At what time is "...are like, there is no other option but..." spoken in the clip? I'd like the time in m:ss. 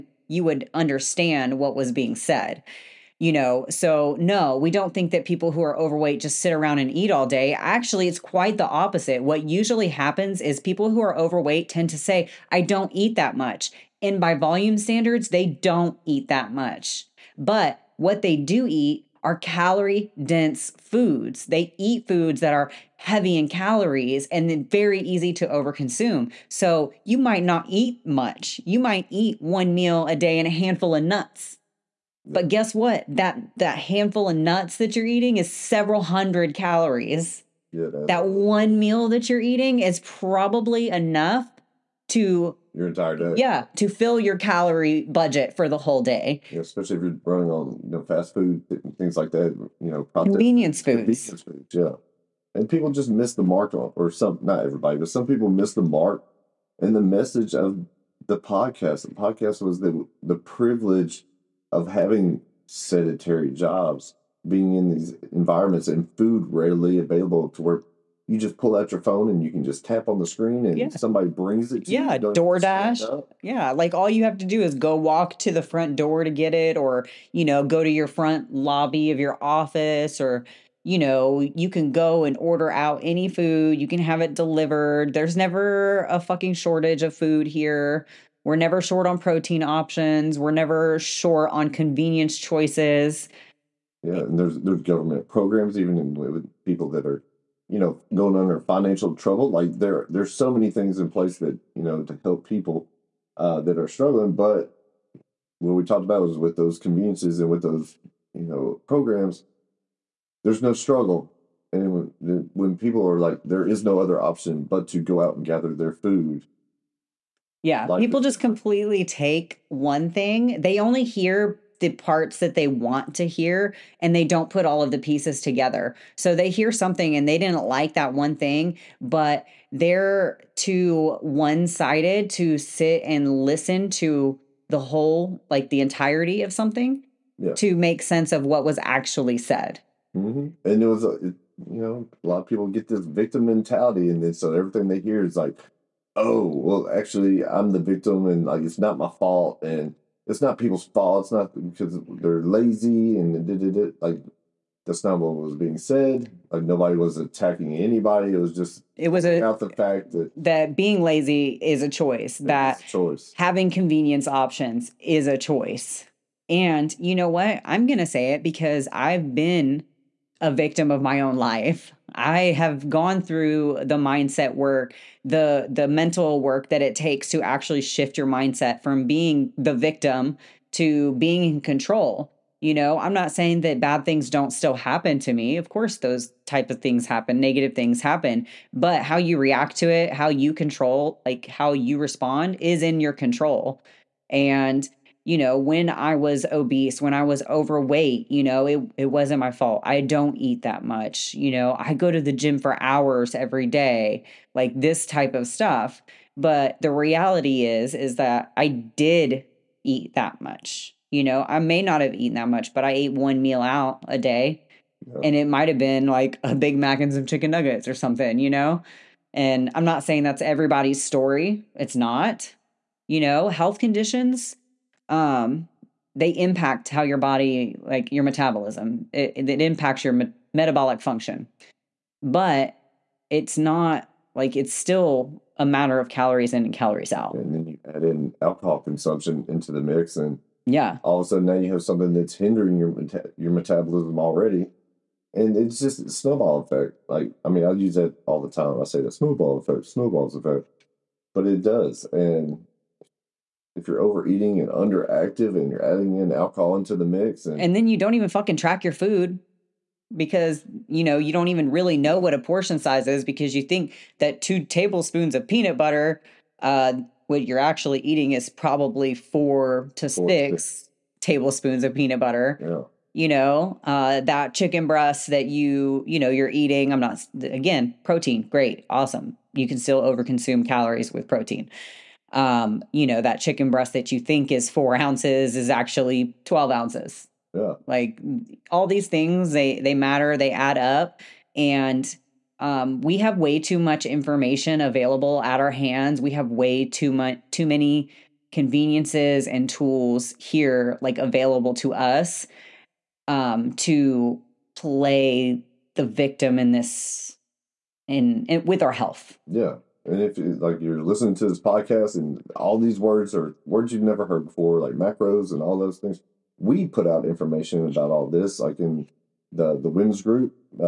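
1:53.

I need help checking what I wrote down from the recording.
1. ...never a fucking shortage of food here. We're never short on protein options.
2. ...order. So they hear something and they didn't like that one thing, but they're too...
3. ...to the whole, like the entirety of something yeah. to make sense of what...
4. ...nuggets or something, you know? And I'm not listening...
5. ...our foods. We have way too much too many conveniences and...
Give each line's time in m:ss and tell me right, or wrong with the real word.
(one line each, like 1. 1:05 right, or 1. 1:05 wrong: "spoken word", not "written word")
1. 1:25 right
2. 2:05 wrong: "together", not "order"
3. 2:13 right
4. 3:37 wrong: "saying", not "listening"
5. 4:55 wrong: "hands", not "foods".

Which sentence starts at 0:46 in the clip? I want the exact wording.
Yeah, especially if you're running on you know, fast food and things like that.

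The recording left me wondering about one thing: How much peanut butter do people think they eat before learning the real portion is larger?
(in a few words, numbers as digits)
2 tablespoons.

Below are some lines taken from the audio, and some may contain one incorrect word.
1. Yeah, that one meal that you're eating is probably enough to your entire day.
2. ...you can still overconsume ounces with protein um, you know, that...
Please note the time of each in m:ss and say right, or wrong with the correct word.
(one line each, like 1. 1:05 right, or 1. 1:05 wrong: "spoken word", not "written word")
1. 0:37 right
2. 4:39 wrong: "calories", not "ounces".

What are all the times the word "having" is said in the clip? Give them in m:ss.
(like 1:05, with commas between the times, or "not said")
1:01, 2:43.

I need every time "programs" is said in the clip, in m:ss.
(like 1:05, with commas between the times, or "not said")
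1:35, 1:48.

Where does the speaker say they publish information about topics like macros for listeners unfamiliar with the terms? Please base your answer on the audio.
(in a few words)
the women's group.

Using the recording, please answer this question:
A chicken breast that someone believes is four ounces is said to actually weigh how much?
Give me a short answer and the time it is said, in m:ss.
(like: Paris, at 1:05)
12 ounces, at 4:46.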